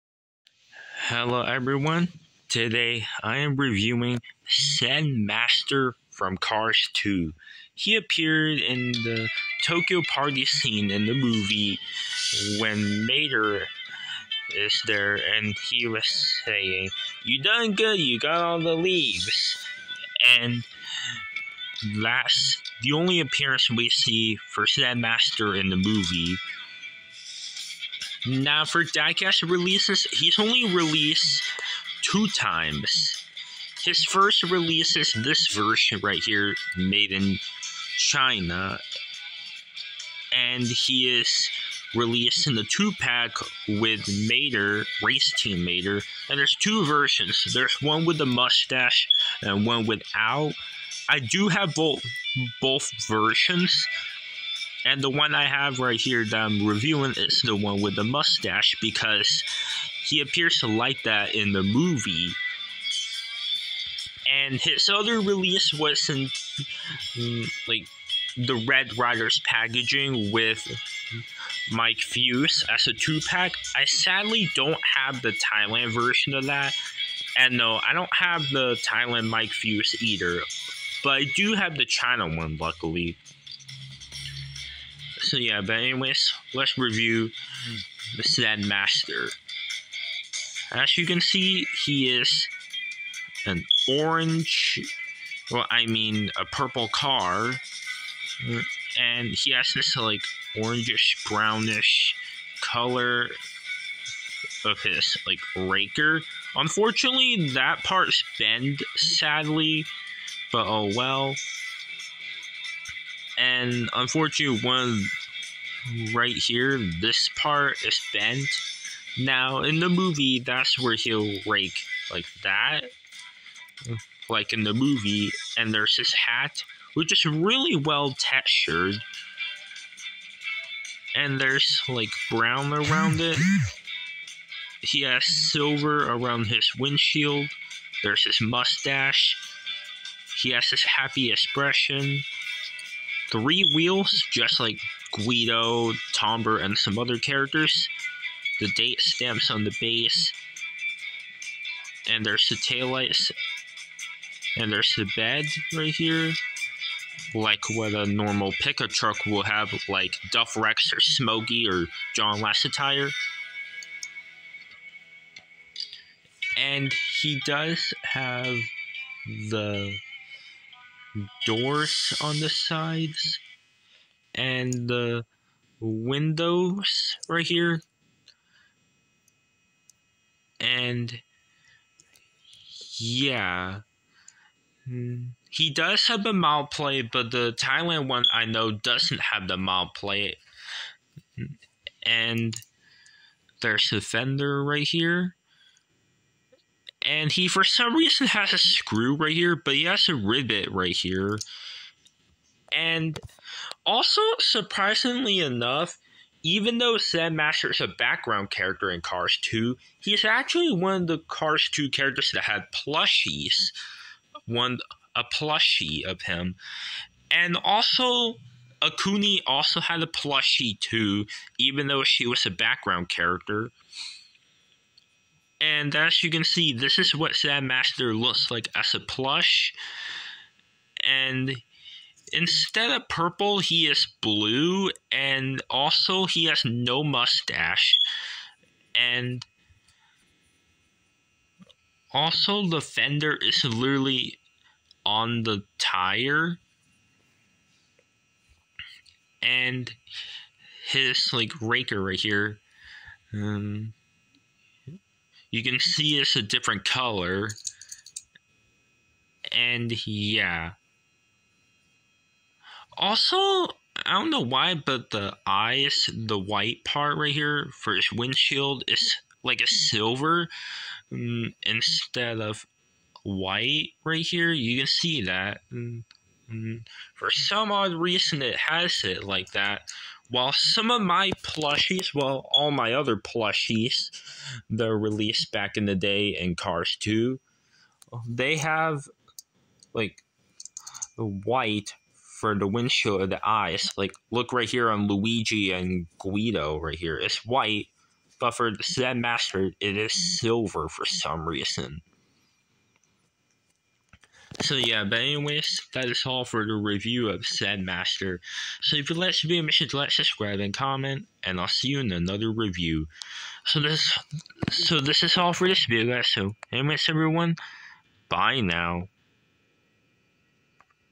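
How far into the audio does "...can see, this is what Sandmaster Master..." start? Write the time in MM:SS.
03:46.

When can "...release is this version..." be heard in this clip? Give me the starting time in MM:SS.
00:34.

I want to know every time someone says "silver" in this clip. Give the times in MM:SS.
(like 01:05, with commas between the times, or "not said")
02:15, 04:29, 05:00.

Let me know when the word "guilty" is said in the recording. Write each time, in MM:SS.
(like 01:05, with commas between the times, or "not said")
not said.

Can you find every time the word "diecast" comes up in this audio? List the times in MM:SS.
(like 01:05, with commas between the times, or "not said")
00:28.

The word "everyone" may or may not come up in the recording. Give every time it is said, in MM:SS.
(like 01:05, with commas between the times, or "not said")
00:01, 05:17.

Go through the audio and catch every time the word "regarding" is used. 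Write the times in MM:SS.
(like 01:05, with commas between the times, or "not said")
not said.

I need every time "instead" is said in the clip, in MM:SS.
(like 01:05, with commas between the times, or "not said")
03:52, 04:31.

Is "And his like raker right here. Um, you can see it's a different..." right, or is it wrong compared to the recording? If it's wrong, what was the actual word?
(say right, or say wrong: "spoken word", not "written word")
right.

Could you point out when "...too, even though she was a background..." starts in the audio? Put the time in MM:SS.
03:40.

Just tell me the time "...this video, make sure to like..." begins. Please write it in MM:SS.
05:09.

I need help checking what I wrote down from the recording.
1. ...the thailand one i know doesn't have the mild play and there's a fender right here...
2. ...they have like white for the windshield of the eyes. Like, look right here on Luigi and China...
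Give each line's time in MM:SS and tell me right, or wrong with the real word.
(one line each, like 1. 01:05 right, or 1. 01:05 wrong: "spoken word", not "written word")
1. 03:07 right
2. 04:48 wrong: "Guido", not "China".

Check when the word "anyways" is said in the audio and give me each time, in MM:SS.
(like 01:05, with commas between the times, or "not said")
01:25, 05:05, 05:16.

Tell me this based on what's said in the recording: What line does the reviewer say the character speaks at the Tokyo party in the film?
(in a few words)
You done good, you got all the leaves.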